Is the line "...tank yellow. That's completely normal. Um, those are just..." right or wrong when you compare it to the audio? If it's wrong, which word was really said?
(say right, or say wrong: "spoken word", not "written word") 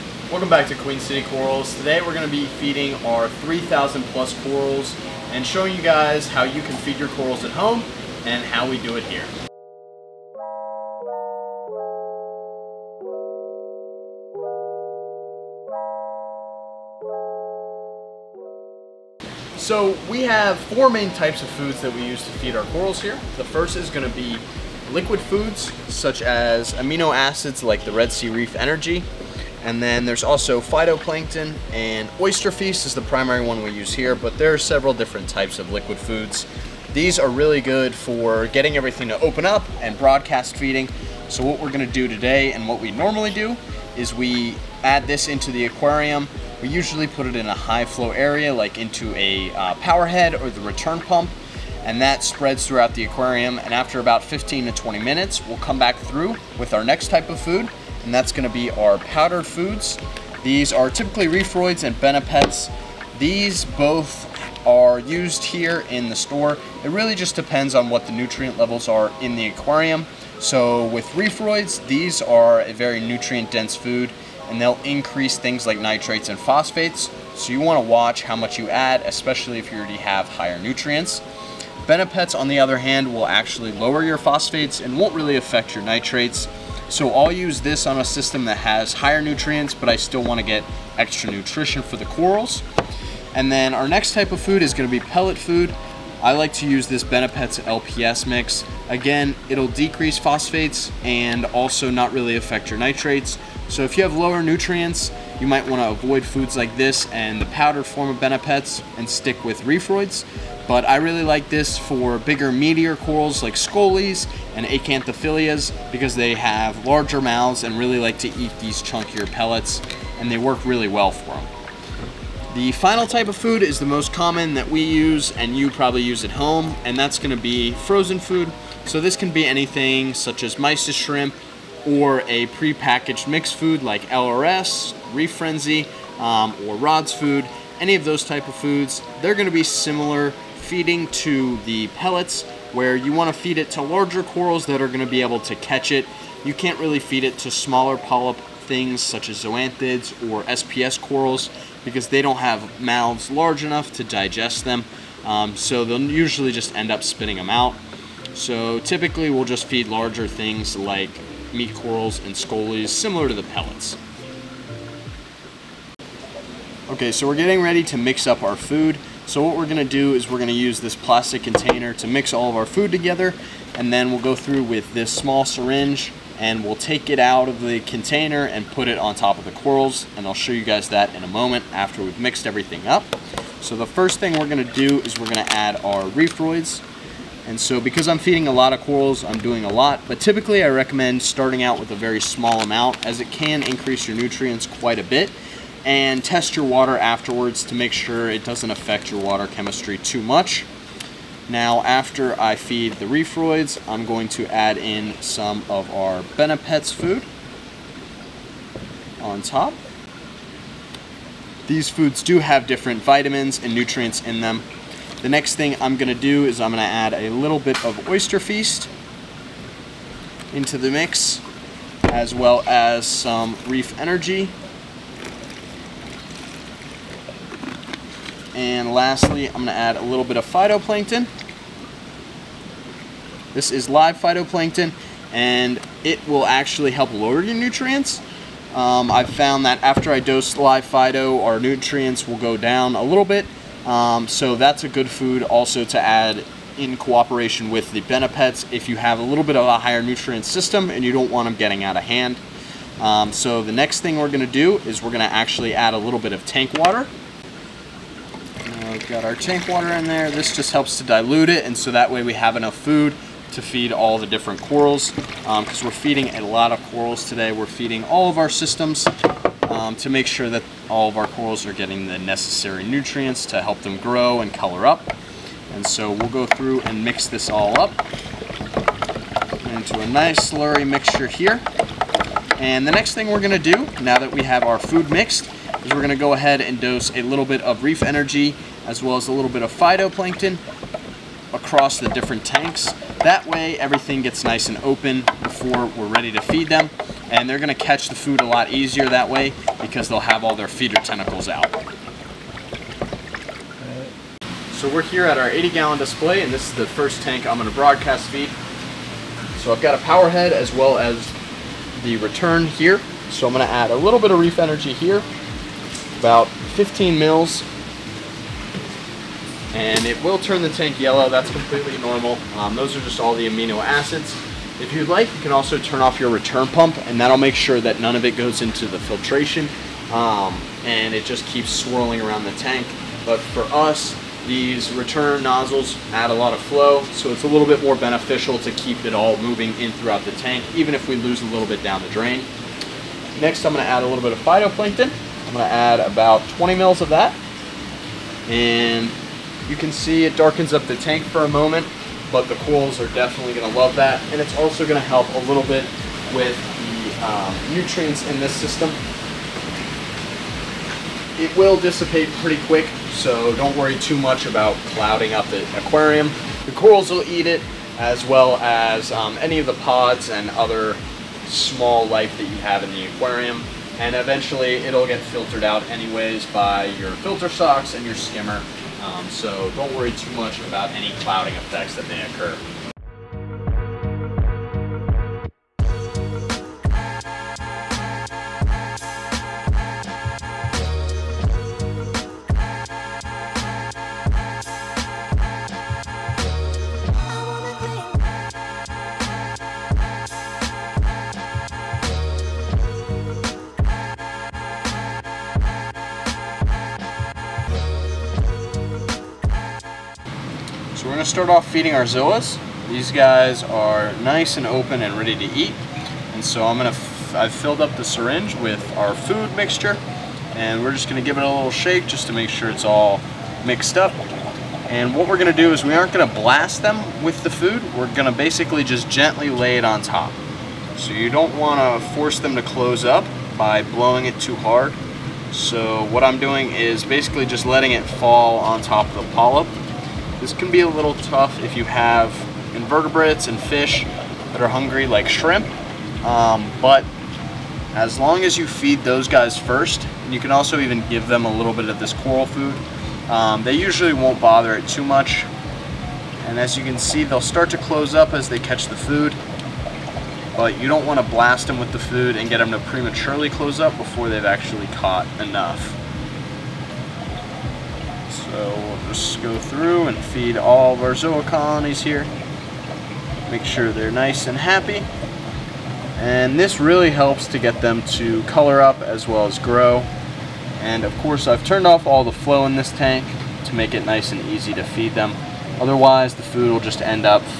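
right.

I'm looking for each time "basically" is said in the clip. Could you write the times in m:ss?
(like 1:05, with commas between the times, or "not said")
7:08, 7:17.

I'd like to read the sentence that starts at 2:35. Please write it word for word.
Um, so they'll usually just end up spitting them out.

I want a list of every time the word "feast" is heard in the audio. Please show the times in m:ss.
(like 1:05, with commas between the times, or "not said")
0:32, 3:38.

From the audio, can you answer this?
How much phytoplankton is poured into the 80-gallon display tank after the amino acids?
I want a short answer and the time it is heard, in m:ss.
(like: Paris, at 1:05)
20 ml, at 5:45.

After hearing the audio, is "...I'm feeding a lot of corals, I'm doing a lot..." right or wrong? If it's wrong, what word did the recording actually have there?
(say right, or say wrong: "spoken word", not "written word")
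right.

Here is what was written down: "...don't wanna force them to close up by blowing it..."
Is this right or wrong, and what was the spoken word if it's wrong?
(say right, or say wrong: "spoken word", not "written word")
right.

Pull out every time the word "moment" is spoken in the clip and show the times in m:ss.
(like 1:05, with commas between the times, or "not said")
3:01, 5:51.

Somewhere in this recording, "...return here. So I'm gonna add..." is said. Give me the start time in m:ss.
5:12.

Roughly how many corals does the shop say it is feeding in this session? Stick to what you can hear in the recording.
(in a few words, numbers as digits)
3,000 plus.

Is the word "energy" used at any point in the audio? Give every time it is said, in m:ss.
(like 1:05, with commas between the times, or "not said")
0:28, 3:43, 4:48, 5:14.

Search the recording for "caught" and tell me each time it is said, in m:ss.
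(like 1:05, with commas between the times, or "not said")
7:44.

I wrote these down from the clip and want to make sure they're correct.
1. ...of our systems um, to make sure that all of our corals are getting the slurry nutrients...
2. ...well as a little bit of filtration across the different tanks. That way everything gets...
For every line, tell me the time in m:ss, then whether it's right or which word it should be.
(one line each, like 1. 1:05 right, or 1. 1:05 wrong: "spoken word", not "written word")
1. 4:28 wrong: "necessary", not "slurry"
2. 4:49 wrong: "phytoplankton", not "filtration".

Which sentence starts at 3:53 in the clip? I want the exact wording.
This is live phytoplankton, and it will actually help lower your nutrients.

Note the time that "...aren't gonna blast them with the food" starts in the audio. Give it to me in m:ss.
7:05.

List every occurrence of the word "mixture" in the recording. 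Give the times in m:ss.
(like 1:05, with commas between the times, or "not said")
4:40, 6:59.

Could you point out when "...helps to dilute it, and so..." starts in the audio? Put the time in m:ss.
4:20.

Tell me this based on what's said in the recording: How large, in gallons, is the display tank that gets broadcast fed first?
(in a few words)
80 gallons.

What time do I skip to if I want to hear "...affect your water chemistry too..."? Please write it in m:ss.
3:18.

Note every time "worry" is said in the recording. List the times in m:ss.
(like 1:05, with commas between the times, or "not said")
6:03, 6:19.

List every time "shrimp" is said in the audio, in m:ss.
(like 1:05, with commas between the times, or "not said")
2:10, 7:25.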